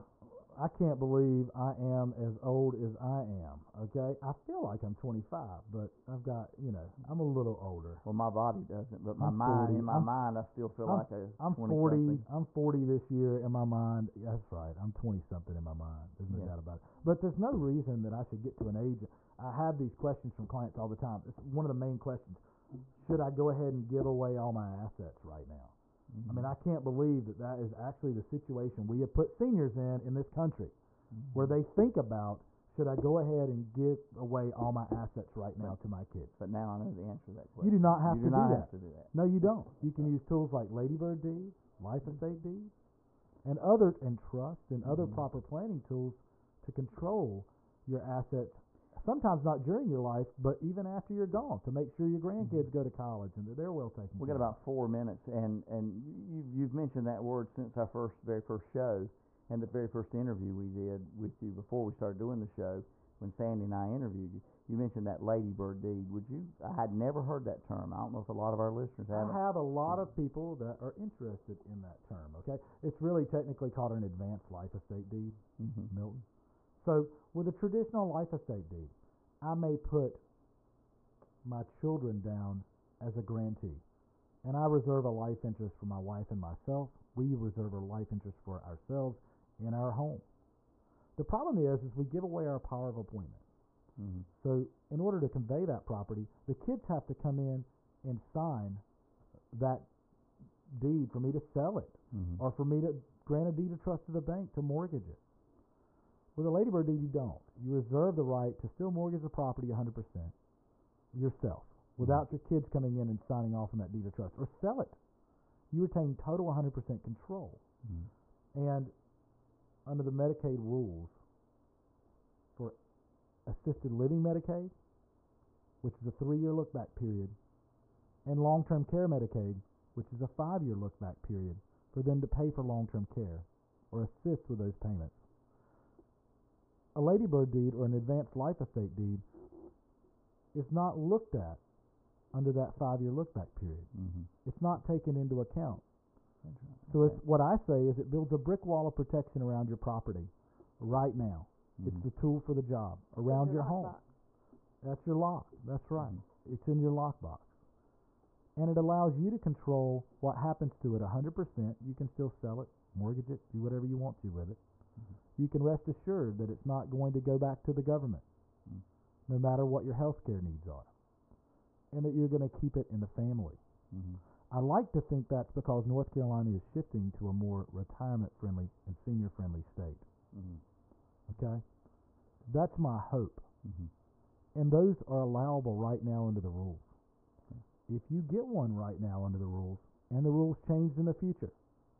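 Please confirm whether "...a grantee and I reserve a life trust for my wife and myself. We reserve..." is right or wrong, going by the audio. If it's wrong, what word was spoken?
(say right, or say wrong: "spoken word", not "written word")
wrong: "interest", not "trust".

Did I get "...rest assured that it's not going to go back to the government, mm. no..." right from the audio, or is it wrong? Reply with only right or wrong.
right.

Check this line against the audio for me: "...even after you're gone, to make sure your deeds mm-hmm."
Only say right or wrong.
wrong.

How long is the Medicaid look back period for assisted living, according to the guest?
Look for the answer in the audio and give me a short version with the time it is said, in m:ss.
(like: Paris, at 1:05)
3 years, at 2:06.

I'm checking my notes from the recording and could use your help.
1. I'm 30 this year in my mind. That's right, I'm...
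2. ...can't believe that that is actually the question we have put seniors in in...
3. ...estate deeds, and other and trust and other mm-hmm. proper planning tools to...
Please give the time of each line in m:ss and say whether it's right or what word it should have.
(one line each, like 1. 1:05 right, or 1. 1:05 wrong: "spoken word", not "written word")
1. 0:12 wrong: "40", not "30"
2. 0:26 wrong: "situation", not "question"
3. 0:42 right.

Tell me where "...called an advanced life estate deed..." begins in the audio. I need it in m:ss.
1:13.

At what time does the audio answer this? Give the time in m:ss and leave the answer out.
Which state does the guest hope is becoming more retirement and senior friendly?
2:55.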